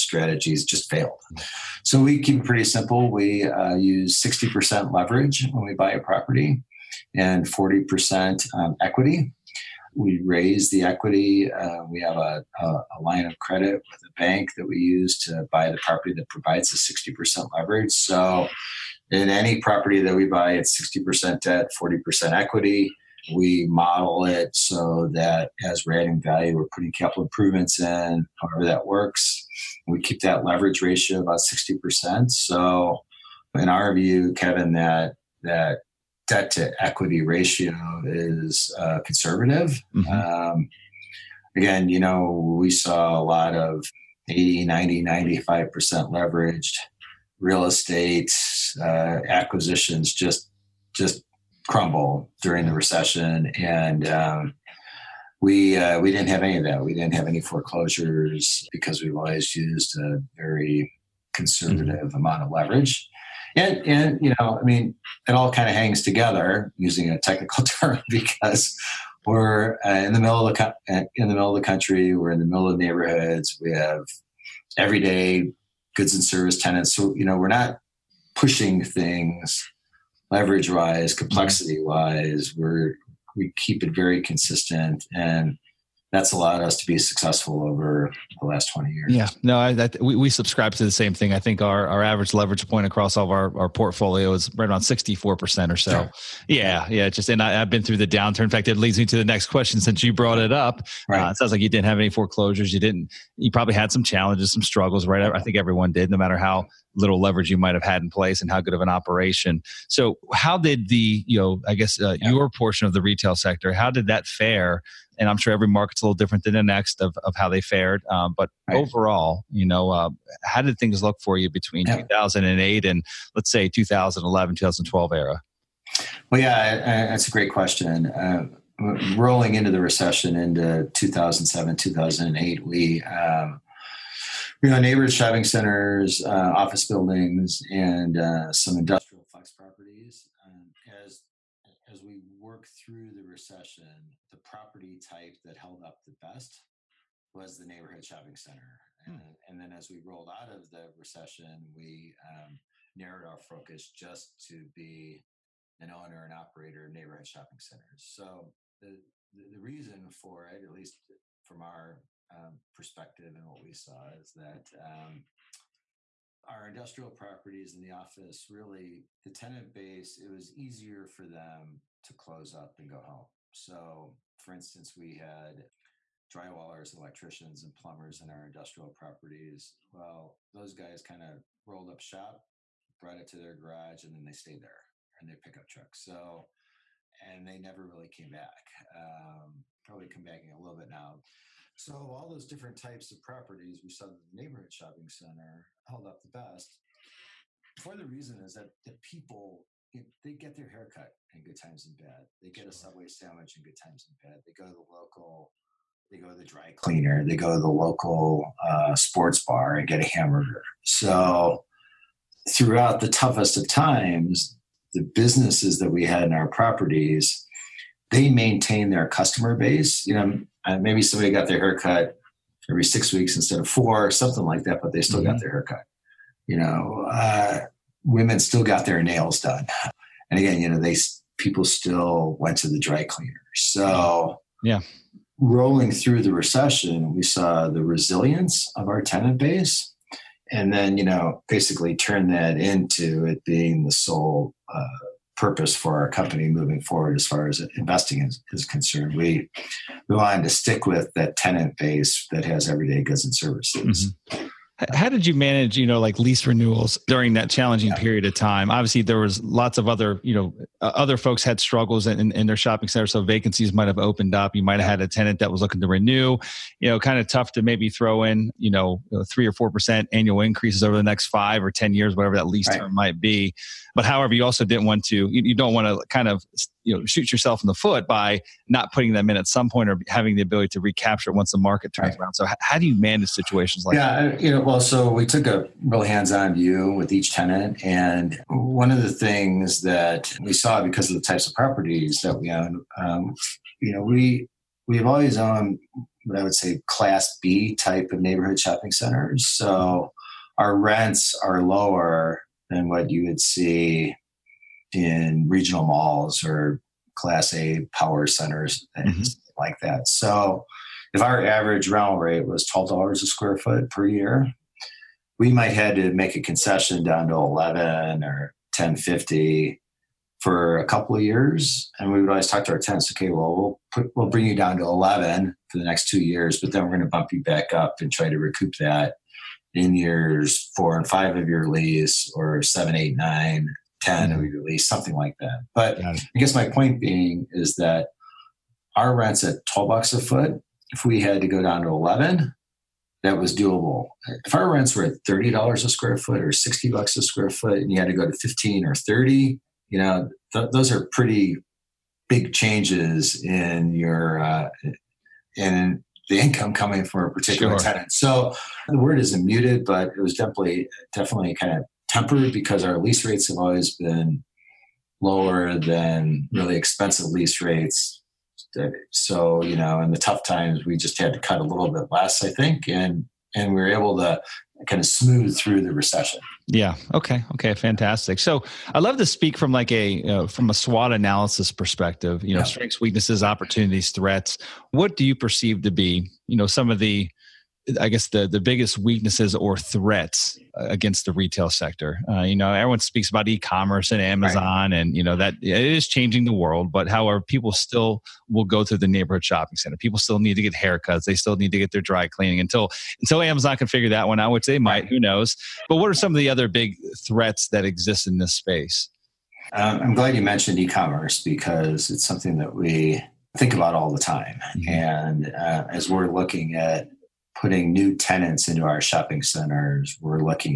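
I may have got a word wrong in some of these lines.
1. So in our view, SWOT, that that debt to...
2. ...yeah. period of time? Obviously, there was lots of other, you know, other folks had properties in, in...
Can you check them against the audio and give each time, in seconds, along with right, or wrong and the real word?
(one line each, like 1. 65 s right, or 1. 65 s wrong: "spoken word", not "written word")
1. 32 s wrong: "Kevin", not "SWOT"
2. 257 s wrong: "struggles", not "properties".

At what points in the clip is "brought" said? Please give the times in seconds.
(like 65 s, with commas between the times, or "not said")
100 s, 182 s.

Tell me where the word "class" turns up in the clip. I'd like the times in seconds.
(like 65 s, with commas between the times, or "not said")
296 s, 307 s.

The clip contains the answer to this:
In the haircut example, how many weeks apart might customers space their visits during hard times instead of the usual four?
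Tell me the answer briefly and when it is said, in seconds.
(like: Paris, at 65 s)
6, at 222 s.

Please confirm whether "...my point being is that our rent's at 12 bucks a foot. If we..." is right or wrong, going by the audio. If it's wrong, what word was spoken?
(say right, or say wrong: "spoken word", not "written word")
right.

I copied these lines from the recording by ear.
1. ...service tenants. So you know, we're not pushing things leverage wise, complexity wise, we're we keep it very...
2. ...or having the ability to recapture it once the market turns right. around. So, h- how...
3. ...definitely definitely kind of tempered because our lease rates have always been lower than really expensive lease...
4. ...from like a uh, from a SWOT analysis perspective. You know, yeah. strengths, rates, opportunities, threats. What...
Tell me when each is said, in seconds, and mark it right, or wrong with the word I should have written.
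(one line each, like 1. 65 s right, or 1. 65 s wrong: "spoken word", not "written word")
1. 76 s right
2. 279 s right
3. 360 s right
4. 379 s wrong: "weaknesses", not "rates".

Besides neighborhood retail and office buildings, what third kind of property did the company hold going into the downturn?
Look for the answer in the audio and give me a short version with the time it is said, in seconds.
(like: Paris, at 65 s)
industrial flex properties, at 138 s.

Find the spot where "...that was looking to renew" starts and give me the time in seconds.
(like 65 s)
265 s.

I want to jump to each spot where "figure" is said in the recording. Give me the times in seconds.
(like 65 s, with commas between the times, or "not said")
403 s.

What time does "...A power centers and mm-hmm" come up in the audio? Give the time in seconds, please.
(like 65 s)
307 s.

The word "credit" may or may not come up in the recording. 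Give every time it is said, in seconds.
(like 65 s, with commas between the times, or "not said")
13 s.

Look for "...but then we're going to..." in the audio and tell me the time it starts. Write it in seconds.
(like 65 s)
326 s.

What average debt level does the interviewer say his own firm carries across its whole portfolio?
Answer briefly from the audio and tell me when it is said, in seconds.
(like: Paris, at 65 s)
64%, at 94 s.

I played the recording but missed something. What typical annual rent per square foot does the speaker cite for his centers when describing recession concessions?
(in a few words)
$12.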